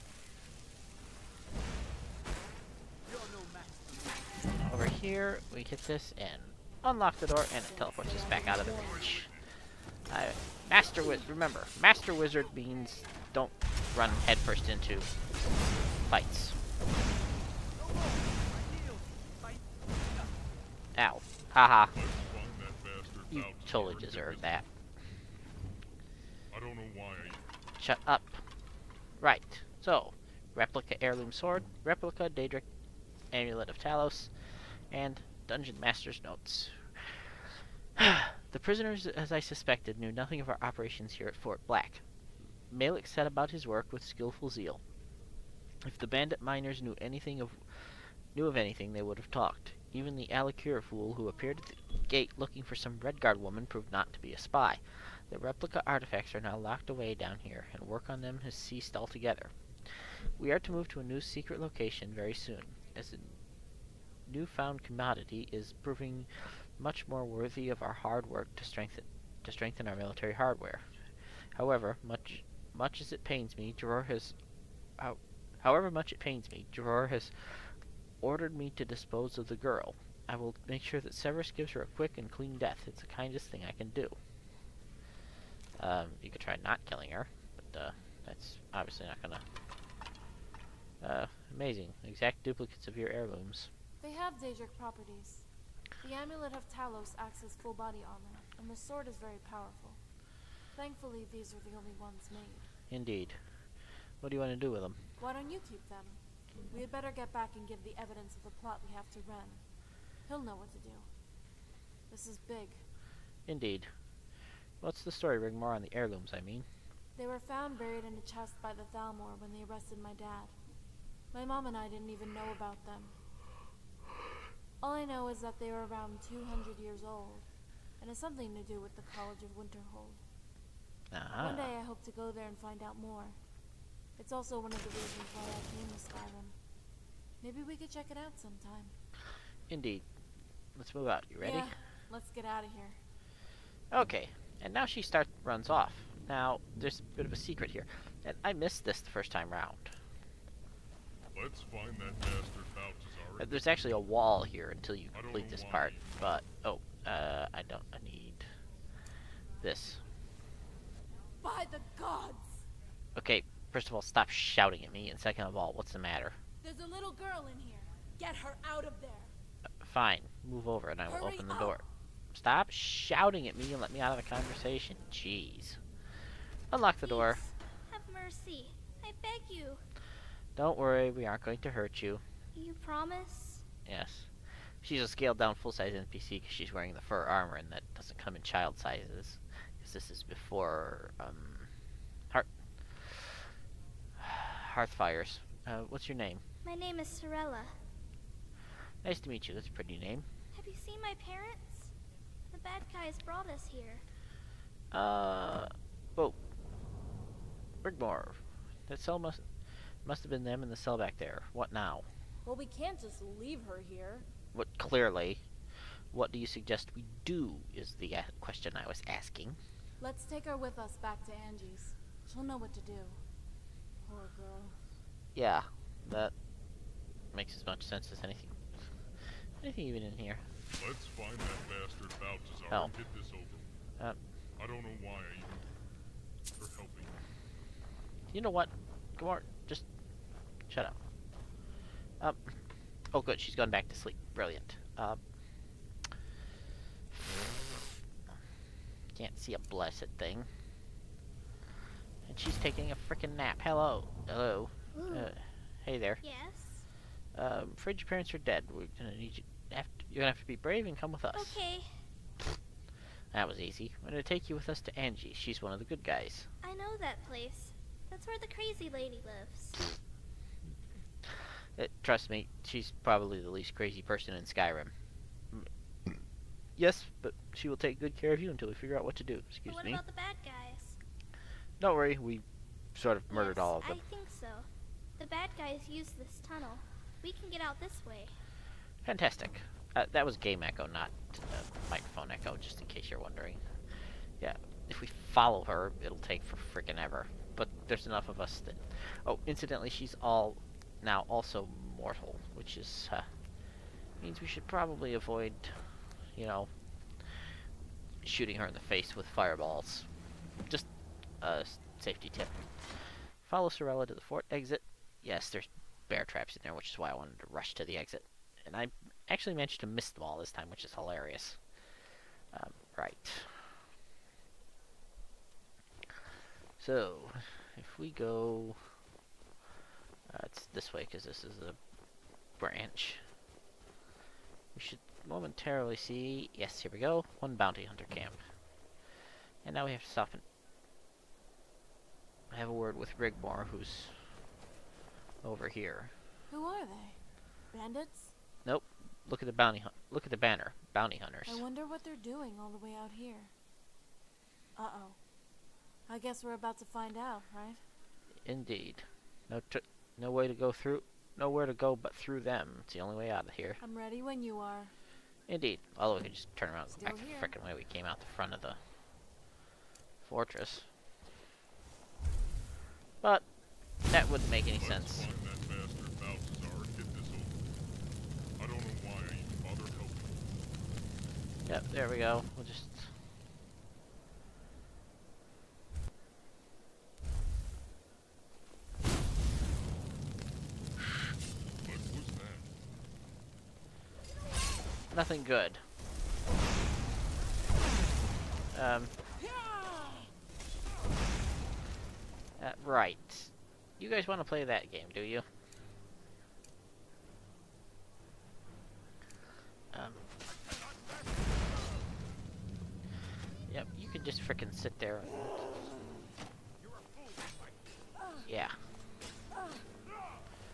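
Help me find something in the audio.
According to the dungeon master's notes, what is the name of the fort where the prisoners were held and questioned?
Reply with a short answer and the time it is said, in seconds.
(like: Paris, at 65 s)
Fort Black, at 41 s.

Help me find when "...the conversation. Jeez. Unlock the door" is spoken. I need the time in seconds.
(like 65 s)
174 s.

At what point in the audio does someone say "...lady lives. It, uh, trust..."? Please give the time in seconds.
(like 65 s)
268 s.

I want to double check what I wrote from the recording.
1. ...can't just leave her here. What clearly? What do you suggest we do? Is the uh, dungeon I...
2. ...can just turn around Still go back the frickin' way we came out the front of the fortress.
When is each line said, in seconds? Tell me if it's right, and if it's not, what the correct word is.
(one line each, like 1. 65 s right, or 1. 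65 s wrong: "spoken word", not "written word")
1. 212 s wrong: "question", not "dungeon"
2. 366 s right.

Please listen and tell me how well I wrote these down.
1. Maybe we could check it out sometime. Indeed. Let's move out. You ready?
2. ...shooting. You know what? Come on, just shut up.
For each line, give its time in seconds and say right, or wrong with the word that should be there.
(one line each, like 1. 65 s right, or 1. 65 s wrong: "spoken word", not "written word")
1. 137 s right
2. 236 s wrong: "helping", not "shooting".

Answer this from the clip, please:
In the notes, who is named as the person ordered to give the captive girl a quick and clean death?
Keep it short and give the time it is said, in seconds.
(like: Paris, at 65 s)
Severus, at 81 s.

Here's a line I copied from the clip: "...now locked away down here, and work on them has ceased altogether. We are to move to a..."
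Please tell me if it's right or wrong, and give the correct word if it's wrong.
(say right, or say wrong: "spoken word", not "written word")
right.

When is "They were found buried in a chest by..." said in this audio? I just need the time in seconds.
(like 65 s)
117 s.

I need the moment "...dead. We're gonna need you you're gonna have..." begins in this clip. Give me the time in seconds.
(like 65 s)
258 s.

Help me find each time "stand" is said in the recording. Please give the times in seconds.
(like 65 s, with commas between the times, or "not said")
not said.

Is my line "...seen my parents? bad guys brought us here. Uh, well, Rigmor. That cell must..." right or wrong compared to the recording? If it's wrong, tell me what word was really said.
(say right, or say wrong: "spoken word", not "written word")
right.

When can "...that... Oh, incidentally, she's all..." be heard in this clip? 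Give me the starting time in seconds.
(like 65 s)
298 s.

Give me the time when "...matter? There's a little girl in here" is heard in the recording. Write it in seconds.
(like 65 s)
165 s.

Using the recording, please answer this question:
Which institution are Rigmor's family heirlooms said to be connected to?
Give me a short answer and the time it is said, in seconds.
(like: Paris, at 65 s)
College of Winterhold, at 129 s.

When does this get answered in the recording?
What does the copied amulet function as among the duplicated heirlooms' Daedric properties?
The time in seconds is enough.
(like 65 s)
97 s.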